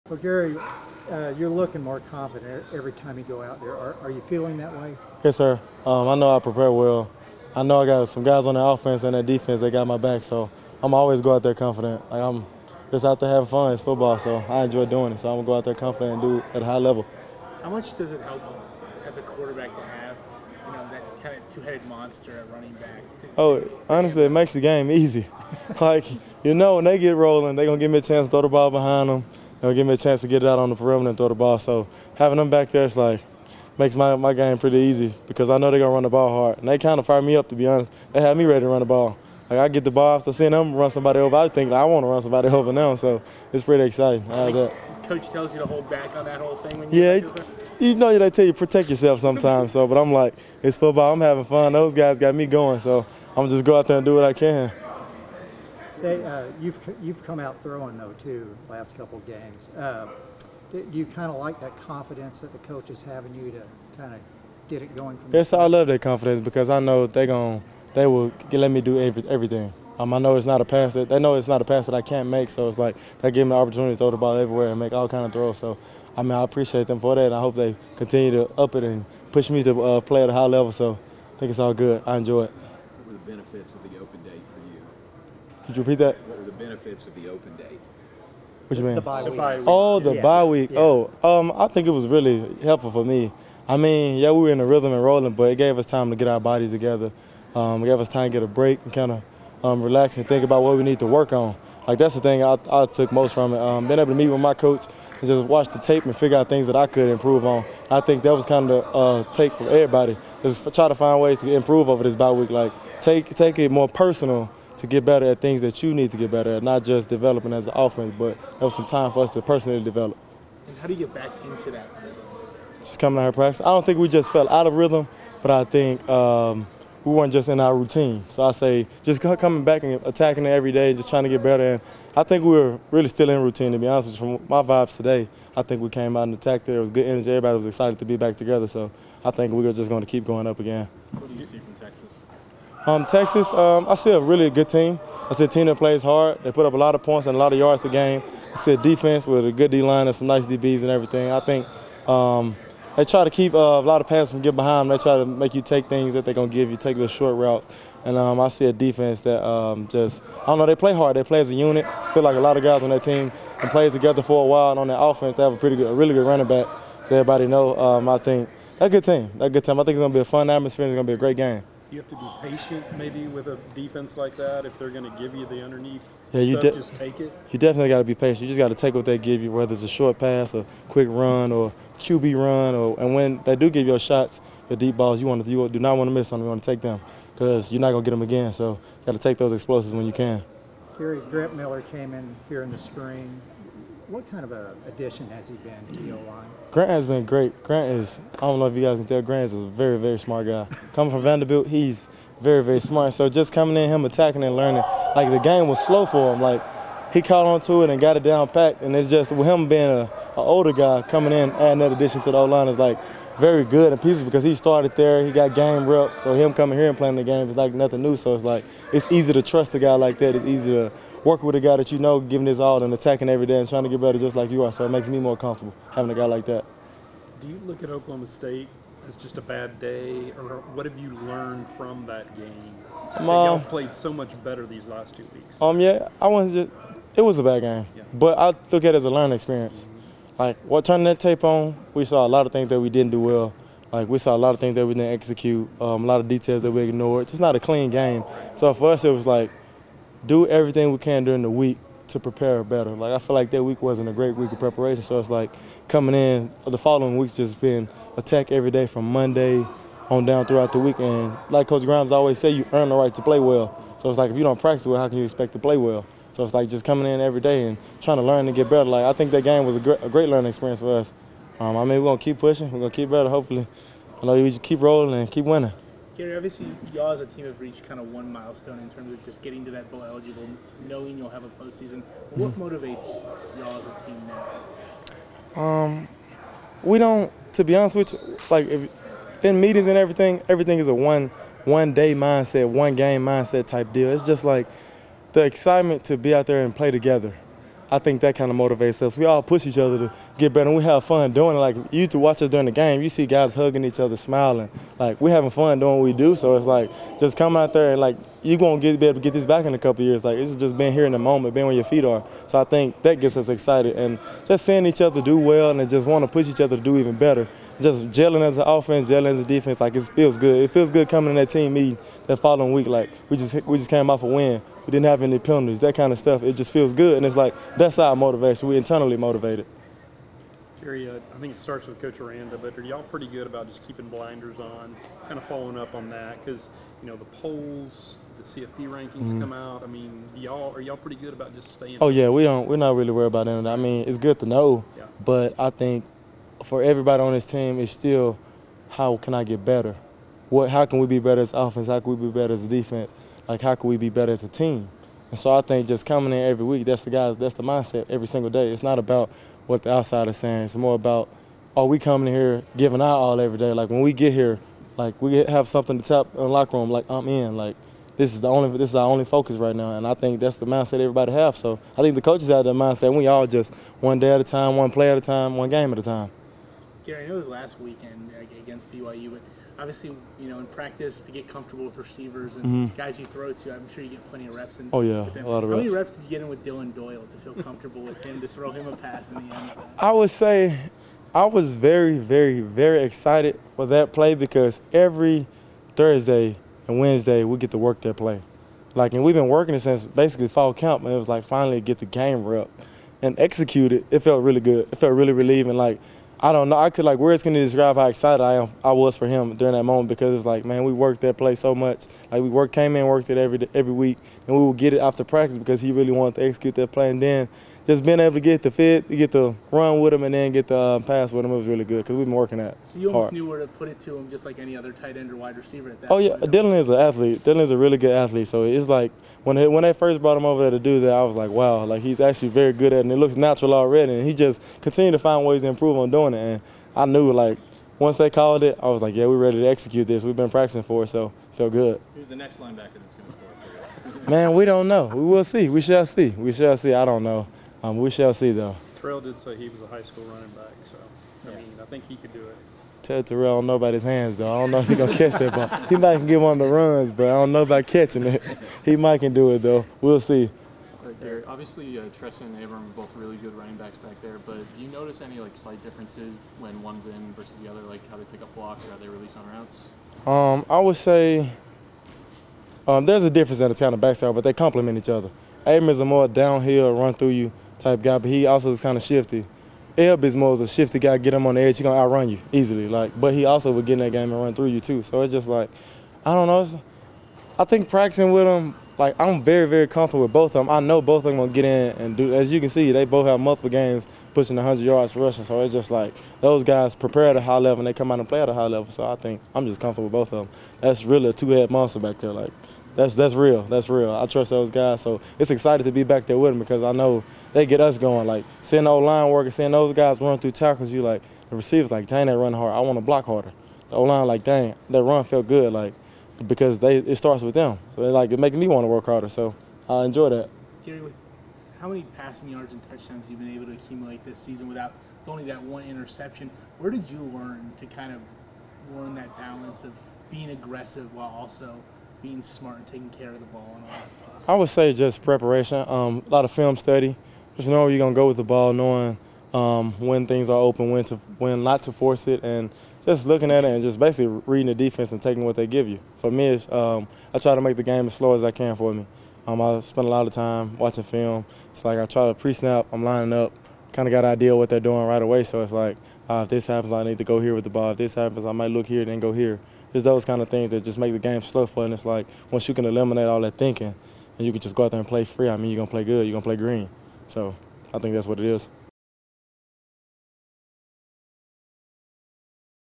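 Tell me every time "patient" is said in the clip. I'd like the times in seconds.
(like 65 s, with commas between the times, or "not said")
172 s, 178 s.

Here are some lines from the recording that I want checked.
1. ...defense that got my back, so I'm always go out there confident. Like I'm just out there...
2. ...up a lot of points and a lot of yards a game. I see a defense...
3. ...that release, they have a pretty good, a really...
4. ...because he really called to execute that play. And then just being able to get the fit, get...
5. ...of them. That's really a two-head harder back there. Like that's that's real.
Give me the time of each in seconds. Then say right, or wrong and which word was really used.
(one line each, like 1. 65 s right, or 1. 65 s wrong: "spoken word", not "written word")
1. 9 s right
2. 146 s right
3. 164 s wrong: "offense", not "release"
4. 415 s wrong: "wanted", not "called"
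5. 500 s wrong: "monster", not "harder".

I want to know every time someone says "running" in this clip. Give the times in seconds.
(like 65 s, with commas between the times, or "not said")
22 s, 166 s, 450 s, 463 s.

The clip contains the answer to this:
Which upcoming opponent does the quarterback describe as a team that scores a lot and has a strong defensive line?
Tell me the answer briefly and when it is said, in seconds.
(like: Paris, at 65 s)
Texas, at 143 s.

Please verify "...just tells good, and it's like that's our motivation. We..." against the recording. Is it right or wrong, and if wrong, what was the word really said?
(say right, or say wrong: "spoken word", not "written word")
wrong: "feels", not "tells".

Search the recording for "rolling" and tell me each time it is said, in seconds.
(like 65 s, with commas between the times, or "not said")
27 s, 95 s, 274 s.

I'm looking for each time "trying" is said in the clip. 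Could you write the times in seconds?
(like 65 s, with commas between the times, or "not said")
131 s, 223 s, 268 s.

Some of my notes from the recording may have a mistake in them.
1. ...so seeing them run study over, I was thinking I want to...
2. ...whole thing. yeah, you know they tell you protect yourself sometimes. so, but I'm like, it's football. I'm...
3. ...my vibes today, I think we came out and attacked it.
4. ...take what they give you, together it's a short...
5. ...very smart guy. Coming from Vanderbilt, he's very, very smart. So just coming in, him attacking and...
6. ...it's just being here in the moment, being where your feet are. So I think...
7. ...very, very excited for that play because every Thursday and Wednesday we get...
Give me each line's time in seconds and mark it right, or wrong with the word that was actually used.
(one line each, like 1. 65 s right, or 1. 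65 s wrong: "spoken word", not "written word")
1. 40 s wrong: "somebody", not "study"
2. 46 s right
3. 134 s right
4. 178 s wrong: "whether", not "together"
5. 199 s right
6. 310 s right
7. 392 s right.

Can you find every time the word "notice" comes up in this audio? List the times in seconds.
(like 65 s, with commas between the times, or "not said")
464 s.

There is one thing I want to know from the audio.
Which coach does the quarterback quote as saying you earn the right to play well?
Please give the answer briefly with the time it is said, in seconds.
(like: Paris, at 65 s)
Coach Grimes, at 261 s.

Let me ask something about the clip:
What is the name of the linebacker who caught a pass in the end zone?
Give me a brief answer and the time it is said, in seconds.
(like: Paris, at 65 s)
Dillon Doyle, at 386 s.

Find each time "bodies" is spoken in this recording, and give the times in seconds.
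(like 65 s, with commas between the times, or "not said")
96 s.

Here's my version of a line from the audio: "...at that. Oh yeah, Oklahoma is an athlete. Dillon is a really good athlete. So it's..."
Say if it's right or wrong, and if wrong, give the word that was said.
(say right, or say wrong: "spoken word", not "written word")
wrong: "Dillon", not "Oklahoma".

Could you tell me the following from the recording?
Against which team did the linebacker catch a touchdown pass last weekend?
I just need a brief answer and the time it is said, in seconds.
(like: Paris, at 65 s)
BYU, at 378 s.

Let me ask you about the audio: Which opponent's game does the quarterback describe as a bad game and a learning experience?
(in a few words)
Oklahoma State.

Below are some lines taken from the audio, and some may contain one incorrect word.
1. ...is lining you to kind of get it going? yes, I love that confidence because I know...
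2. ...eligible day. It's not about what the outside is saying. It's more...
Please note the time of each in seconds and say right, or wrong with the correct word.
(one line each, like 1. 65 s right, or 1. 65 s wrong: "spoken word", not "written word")
1. 62 s wrong: "having", not "lining"
2. 358 s wrong: "single", not "eligible".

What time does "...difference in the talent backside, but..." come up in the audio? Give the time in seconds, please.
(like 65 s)
473 s.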